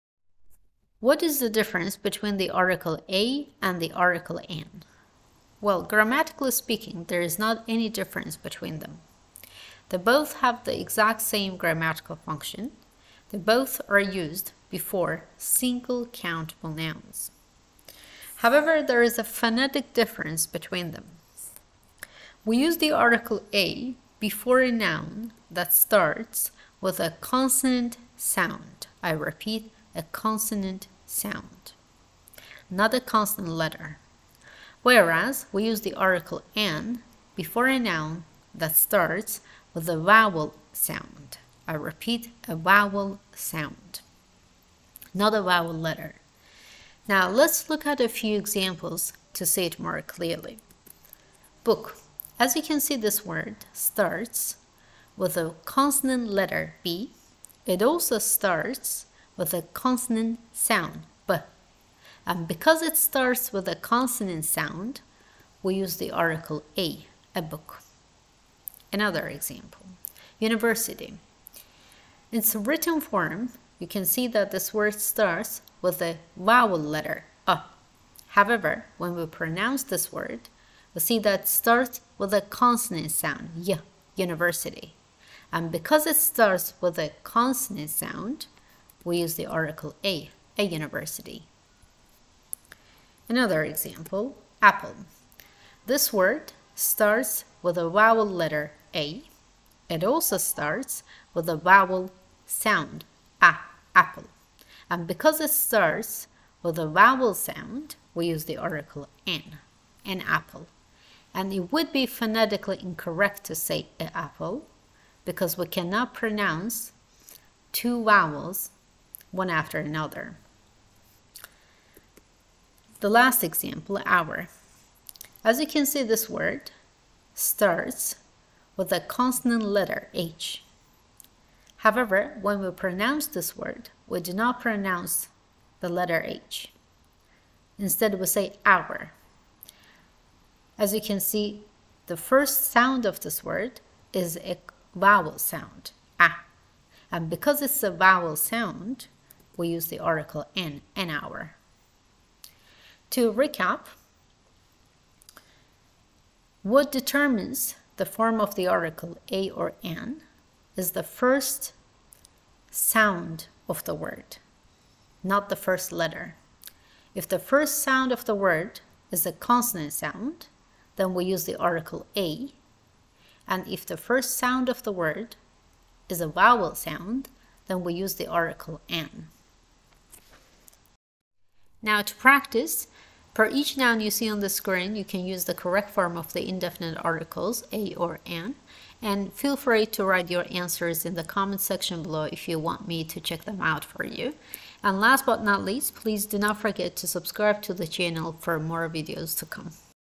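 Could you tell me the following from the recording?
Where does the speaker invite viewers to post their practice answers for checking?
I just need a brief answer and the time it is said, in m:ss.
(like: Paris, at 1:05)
The comment section, at 3:11.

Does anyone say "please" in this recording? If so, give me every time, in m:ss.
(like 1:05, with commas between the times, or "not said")
3:15.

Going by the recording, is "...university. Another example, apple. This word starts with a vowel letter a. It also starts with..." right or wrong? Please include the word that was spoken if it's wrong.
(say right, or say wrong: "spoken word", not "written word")
right.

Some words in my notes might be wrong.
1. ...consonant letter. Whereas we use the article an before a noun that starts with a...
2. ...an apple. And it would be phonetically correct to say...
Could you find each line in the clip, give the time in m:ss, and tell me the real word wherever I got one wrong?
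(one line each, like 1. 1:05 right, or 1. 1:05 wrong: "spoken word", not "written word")
1. 0:33 right
2. 1:50 wrong: "incorrect", not "correct".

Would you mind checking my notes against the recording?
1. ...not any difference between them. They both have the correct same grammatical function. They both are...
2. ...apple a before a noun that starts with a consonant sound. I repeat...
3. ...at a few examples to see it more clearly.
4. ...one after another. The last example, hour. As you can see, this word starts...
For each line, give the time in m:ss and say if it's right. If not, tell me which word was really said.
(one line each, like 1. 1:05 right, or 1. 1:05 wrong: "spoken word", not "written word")
1. 0:07 wrong: "exact", not "correct"
2. 0:22 wrong: "article", not "apple"
3. 0:47 right
4. 1:59 right.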